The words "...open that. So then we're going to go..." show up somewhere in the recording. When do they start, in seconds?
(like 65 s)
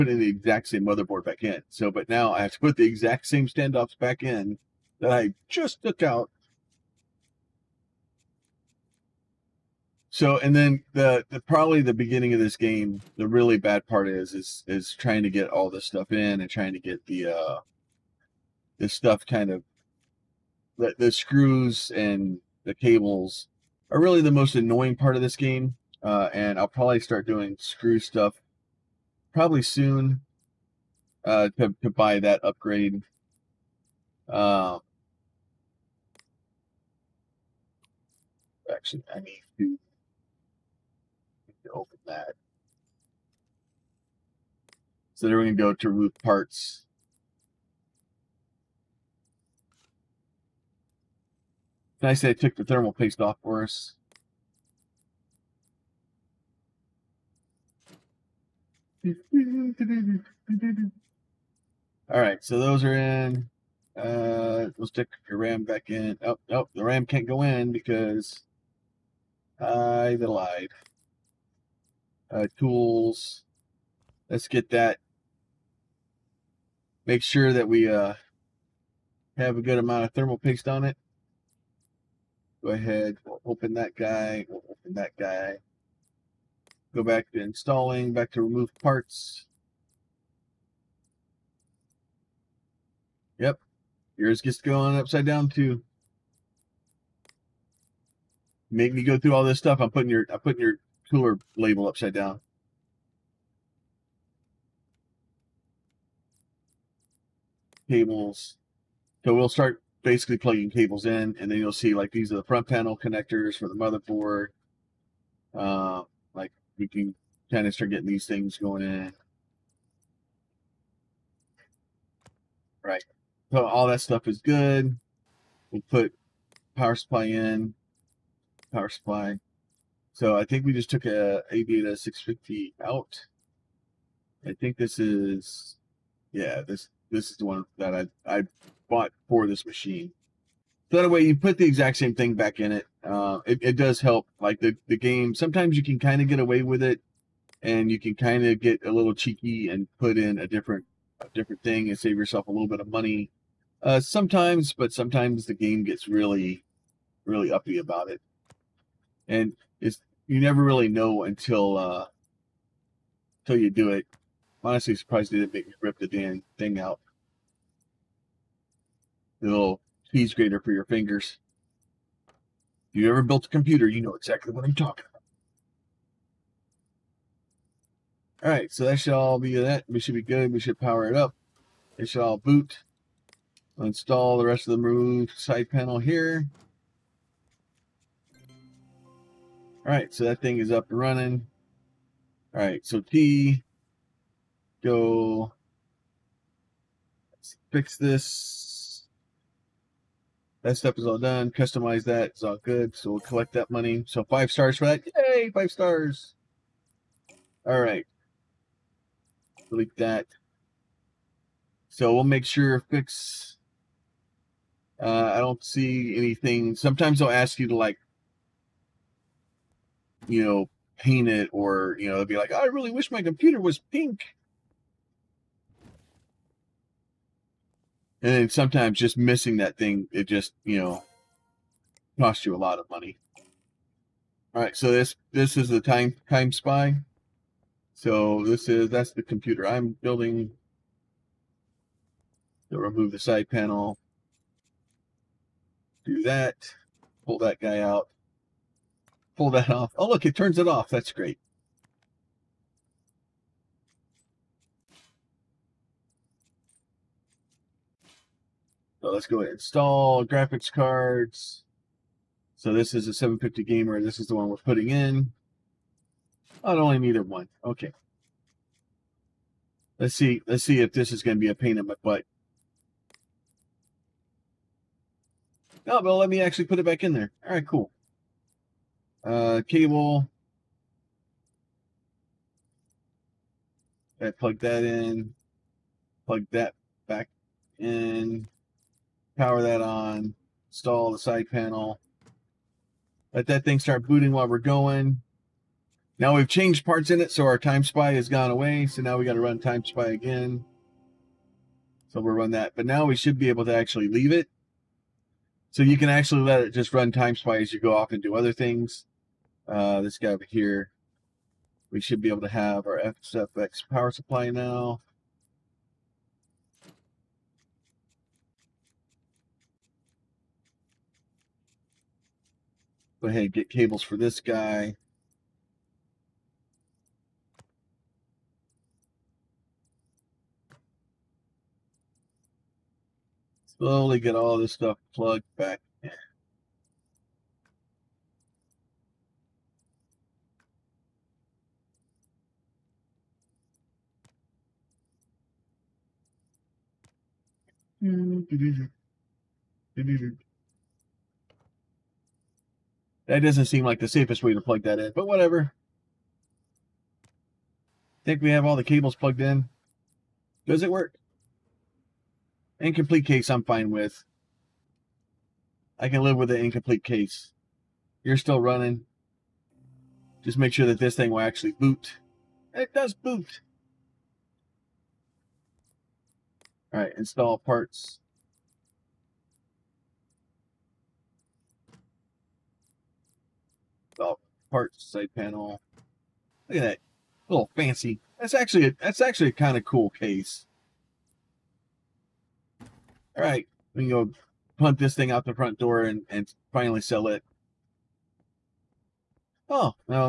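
41 s.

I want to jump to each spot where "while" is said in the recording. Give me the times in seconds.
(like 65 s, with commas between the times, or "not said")
294 s.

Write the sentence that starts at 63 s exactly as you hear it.
Uh, we'll stick your RAM back in.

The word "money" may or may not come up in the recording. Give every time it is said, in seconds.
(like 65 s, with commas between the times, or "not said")
152 s, 203 s, 232 s.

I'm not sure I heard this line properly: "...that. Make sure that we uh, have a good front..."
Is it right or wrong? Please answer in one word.
wrong.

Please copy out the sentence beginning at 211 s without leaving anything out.
So we'll make sure fix, uh, I don't see anything.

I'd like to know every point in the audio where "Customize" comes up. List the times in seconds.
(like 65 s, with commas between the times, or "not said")
201 s.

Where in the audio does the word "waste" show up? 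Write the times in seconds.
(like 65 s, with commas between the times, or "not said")
not said.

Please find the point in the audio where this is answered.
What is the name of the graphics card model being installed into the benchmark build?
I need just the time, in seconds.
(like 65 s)
263 s.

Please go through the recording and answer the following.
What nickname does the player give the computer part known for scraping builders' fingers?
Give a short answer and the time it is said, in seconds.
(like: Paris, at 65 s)
cheese grater, at 170 s.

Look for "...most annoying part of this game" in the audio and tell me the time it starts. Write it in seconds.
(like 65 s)
24 s.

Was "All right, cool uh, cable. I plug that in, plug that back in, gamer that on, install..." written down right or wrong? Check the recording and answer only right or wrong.
wrong.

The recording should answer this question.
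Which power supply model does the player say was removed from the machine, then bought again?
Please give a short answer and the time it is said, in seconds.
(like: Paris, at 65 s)
Aviator 650, at 131 s.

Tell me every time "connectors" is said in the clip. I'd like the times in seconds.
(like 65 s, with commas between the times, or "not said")
112 s.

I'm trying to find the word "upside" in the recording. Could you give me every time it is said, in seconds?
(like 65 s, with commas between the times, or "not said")
94 s, 101 s.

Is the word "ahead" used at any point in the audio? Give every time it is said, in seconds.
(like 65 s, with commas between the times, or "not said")
82 s, 323 s.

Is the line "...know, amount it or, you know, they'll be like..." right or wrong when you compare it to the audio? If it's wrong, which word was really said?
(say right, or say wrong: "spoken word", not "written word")
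wrong: "paint", not "amount".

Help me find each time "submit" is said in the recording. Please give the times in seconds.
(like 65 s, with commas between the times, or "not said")
not said.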